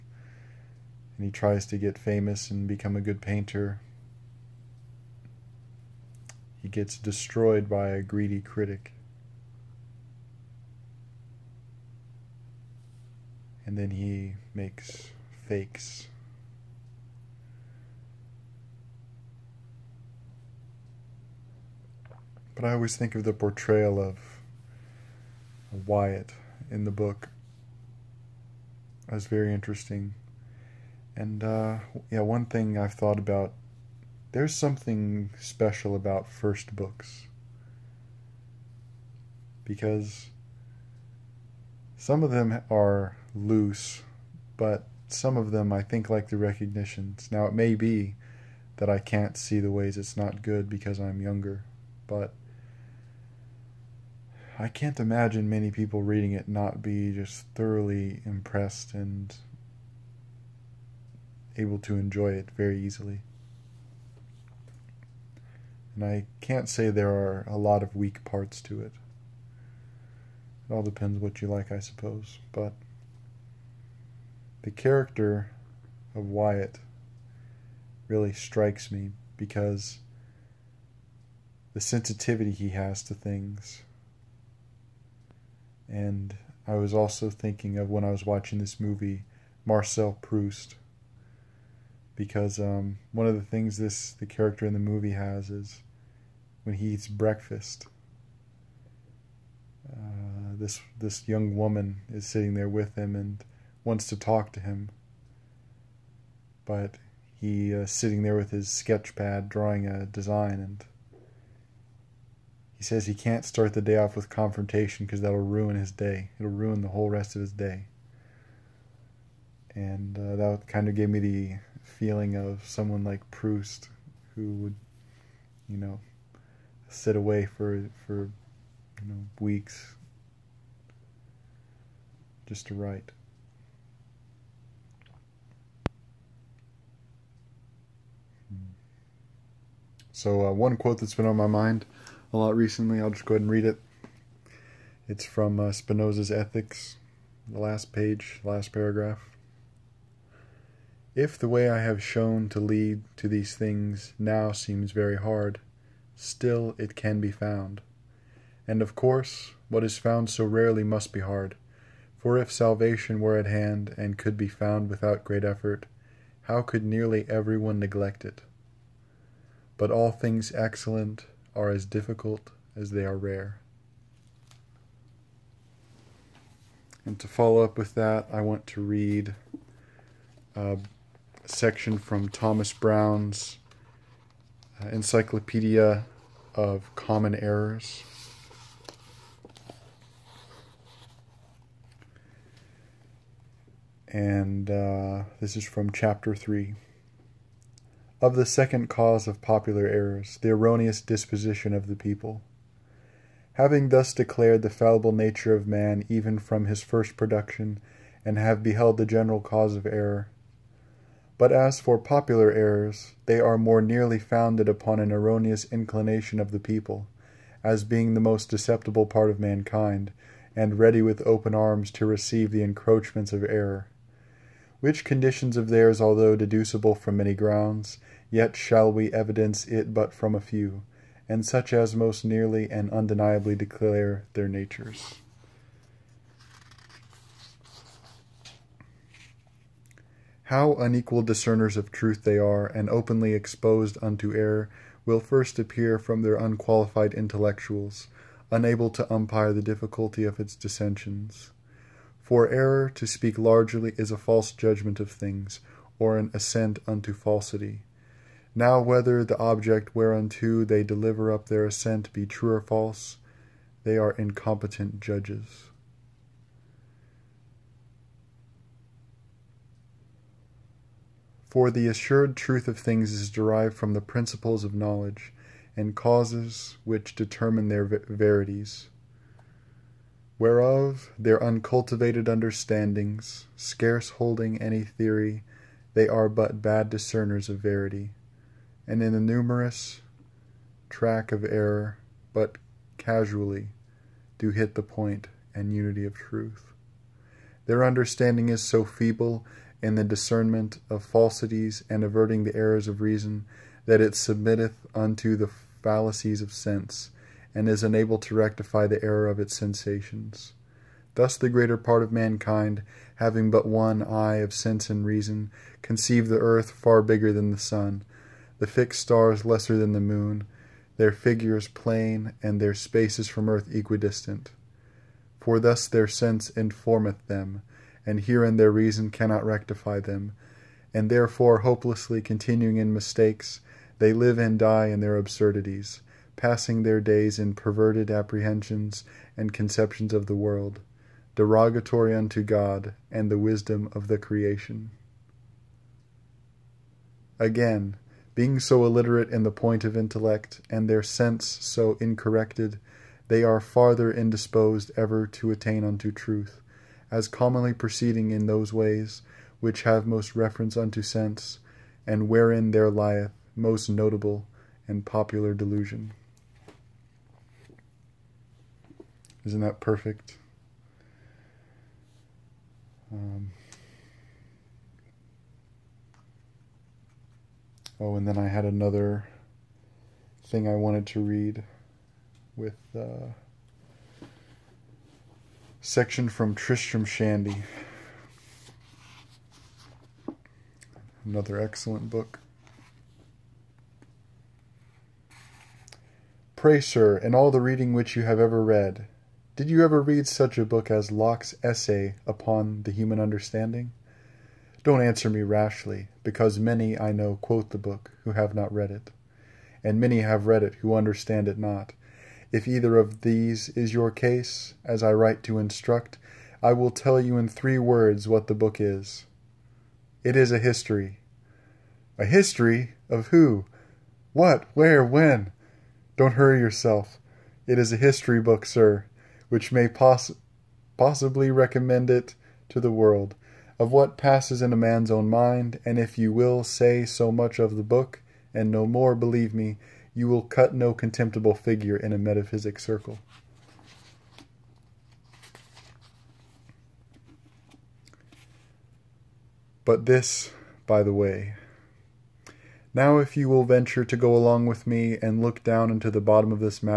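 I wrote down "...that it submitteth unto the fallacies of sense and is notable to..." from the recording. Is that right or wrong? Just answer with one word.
wrong.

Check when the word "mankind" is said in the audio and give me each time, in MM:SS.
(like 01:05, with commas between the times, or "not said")
03:39, 05:12.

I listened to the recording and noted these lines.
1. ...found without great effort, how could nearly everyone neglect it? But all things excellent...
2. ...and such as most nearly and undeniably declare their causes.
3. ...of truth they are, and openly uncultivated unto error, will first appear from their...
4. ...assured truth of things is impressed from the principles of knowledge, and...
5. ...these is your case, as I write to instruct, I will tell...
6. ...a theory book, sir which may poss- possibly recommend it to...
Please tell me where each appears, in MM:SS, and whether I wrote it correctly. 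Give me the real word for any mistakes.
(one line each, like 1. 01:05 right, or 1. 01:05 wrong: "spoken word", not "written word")
1. 02:44 right
2. 03:51 wrong: "natures", not "causes"
3. 04:01 wrong: "exposed", not "uncultivated"
4. 04:31 wrong: "derived", not "impressed"
5. 06:53 right
6. 07:07 wrong: "history", not "theory".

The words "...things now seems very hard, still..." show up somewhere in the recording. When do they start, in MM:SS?
02:33.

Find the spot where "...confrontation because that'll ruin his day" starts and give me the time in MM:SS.
01:54.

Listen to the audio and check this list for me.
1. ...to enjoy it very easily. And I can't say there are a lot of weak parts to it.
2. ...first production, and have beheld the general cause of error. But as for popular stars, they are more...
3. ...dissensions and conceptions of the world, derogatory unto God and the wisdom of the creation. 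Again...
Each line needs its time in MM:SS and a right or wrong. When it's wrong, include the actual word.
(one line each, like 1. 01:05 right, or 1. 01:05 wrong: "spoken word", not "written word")
1. 01:01 right
2. 03:26 wrong: "errors", not "stars"
3. 05:38 wrong: "apprehensions", not "dissensions".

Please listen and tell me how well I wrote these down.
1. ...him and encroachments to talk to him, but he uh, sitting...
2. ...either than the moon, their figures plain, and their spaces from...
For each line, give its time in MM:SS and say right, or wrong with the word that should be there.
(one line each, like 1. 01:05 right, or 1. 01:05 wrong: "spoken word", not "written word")
1. 01:42 wrong: "wants", not "encroachments"
2. 05:19 wrong: "lesser", not "either".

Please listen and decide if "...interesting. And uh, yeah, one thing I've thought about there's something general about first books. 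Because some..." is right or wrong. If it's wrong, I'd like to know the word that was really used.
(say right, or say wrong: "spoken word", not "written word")
wrong: "special", not "general".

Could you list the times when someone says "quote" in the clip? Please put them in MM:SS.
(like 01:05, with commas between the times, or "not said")
02:20, 06:47.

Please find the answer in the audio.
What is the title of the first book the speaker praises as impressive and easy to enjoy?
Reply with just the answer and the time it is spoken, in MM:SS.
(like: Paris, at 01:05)
The Recognitions, at 00:46.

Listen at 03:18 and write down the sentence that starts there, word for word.
Of the second cause of popular errors, the erroneous disposition of the people.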